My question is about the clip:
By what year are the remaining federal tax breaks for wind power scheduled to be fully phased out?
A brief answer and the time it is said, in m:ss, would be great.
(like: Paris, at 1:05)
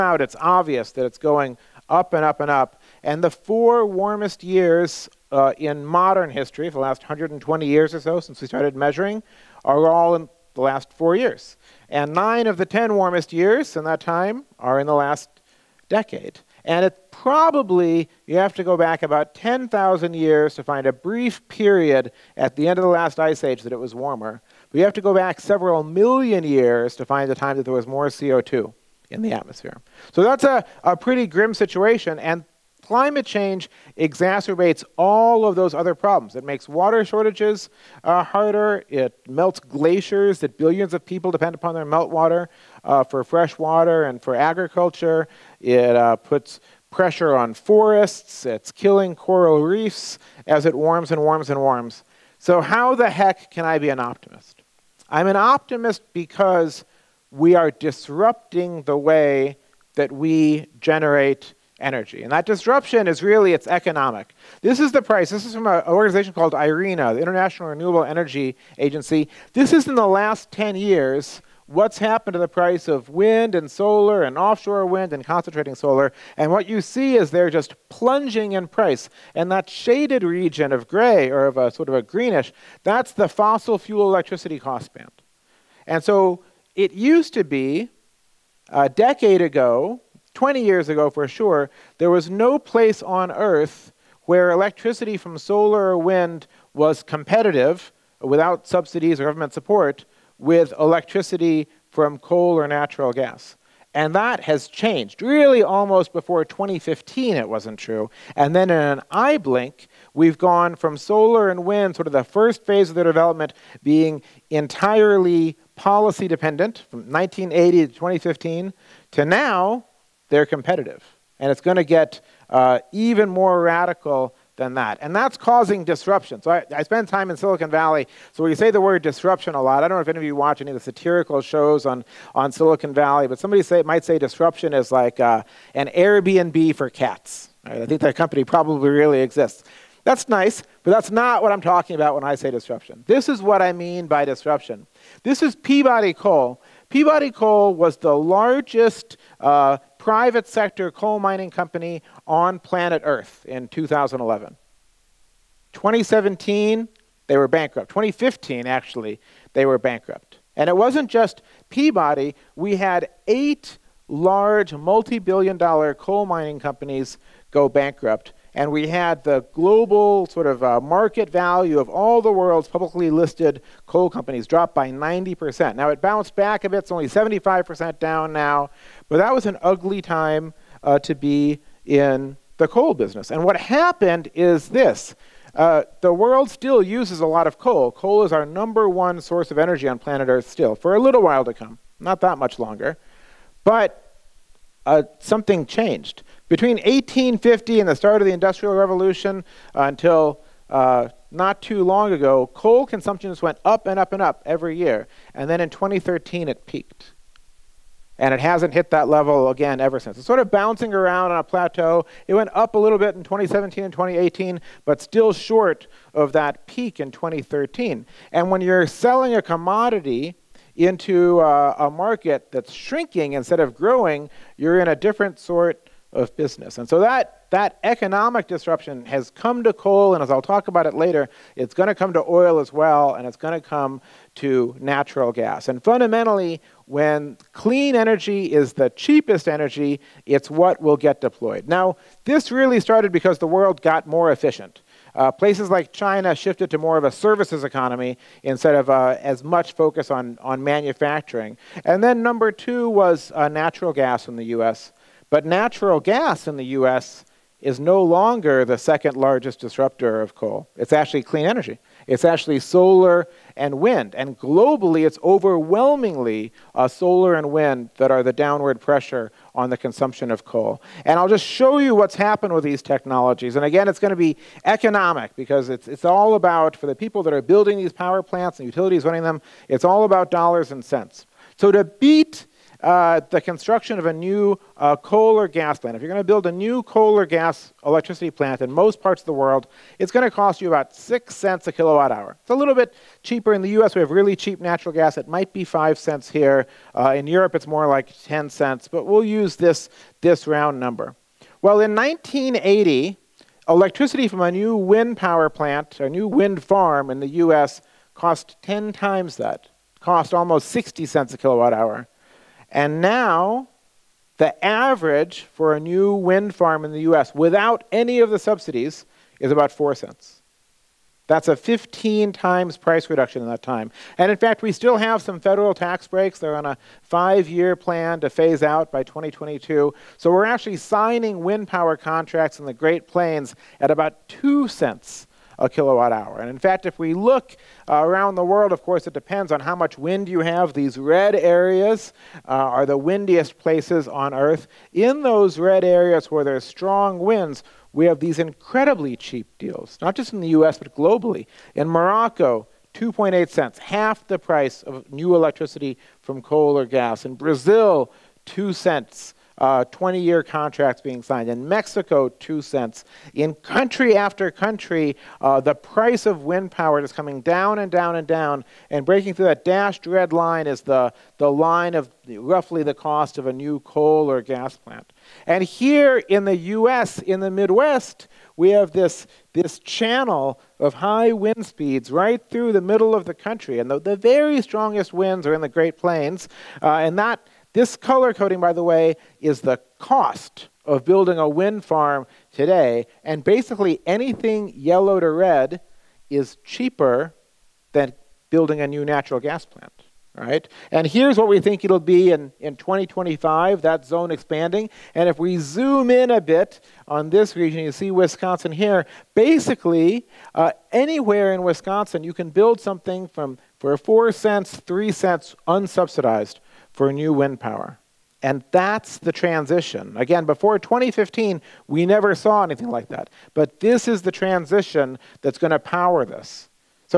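2022, at 5:29.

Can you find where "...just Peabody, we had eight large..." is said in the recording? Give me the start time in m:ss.
2:41.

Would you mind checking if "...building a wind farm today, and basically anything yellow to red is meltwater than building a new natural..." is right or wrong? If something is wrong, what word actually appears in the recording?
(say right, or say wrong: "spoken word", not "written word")
wrong: "cheaper", not "meltwater".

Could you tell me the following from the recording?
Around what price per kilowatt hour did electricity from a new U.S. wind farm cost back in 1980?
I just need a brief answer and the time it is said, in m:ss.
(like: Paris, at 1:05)
60 cents, at 5:10.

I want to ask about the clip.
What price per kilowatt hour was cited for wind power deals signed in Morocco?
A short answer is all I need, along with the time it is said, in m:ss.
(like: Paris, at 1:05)
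2.8 cents, at 5:52.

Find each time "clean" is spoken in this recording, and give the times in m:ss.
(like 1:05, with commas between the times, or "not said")
3:57, 4:21.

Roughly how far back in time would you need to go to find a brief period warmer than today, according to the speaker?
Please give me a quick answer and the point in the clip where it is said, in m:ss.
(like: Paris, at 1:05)
10,000 years, at 0:19.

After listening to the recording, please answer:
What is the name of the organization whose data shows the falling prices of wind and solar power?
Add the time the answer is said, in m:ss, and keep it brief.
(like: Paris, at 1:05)
International Renewable Energy Agency, at 1:07.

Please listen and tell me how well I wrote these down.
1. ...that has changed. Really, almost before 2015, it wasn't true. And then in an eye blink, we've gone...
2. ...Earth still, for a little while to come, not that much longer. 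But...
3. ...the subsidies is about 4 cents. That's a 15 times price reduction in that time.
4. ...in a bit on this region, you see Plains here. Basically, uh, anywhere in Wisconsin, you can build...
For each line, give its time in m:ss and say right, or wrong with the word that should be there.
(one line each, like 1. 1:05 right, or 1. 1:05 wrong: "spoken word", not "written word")
1. 1:44 right
2. 3:10 right
3. 5:18 right
4. 6:46 wrong: "Wisconsin", not "Plains".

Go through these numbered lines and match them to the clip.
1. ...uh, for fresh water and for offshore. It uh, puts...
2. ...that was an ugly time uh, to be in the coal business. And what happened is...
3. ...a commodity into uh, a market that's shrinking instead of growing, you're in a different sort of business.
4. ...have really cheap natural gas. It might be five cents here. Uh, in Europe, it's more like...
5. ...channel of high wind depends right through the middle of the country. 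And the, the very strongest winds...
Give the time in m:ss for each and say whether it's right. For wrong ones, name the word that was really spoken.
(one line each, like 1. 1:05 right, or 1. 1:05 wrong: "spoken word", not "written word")
1. 0:42 wrong: "agriculture", not "offshore"
2. 2:59 right
3. 3:39 right
4. 4:54 right
5. 6:19 wrong: "speeds", not "depends".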